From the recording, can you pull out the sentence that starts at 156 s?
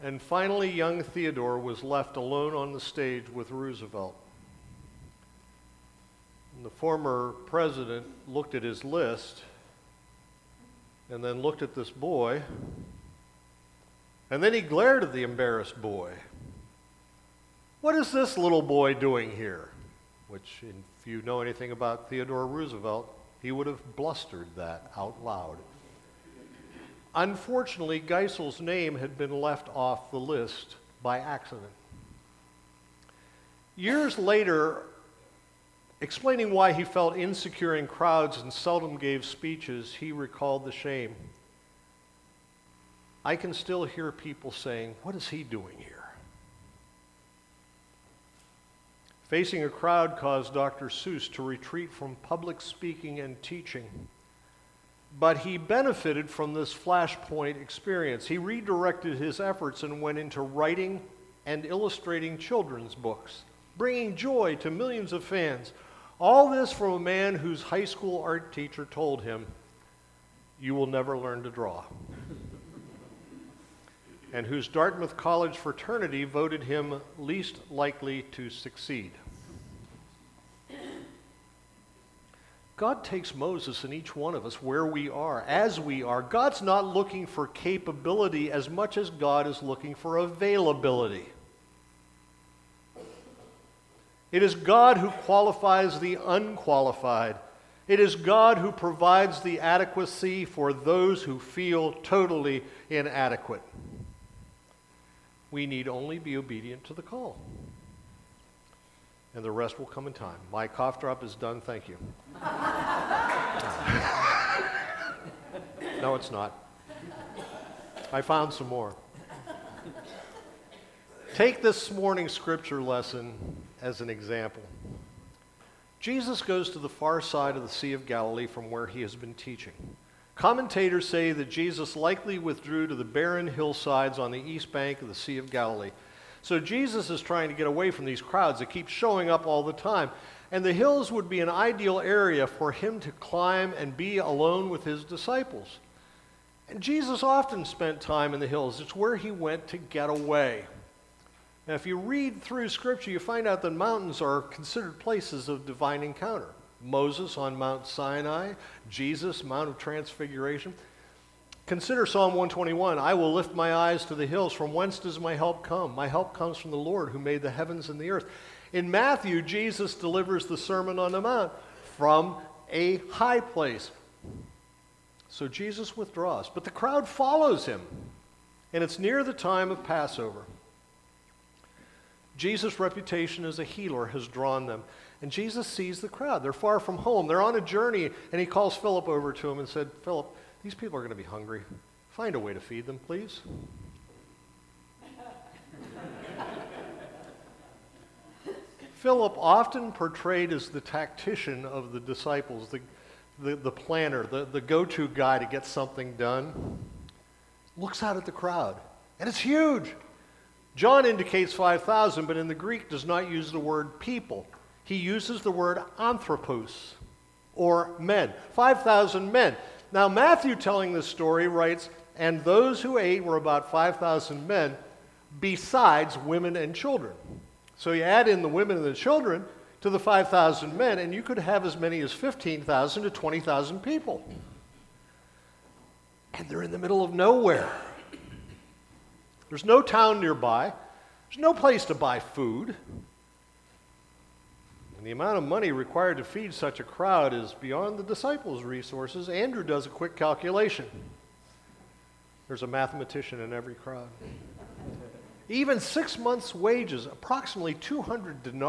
Moses on Mount Sinai, Jesus, Mount of Transfiguration.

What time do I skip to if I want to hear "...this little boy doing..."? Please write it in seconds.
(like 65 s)
18 s.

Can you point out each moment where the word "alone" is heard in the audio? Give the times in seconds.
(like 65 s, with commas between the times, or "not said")
2 s, 144 s.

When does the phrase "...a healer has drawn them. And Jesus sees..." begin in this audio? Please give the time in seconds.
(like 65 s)
183 s.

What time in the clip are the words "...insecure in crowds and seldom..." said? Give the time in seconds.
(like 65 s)
37 s.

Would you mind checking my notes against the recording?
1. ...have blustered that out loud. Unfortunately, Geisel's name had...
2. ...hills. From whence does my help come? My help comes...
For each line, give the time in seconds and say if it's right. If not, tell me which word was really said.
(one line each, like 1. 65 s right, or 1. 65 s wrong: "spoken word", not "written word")
1. 23 s right
2. 164 s right.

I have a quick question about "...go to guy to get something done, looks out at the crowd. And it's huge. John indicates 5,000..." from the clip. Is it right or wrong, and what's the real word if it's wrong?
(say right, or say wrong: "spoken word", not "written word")
right.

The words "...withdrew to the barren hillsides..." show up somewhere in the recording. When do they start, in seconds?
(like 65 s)
132 s.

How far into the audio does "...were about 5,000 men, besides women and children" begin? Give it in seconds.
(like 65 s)
223 s.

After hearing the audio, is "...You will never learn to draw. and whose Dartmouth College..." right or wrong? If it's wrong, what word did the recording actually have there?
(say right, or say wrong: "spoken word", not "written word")
right.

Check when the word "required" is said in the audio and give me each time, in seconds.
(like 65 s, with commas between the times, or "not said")
245 s.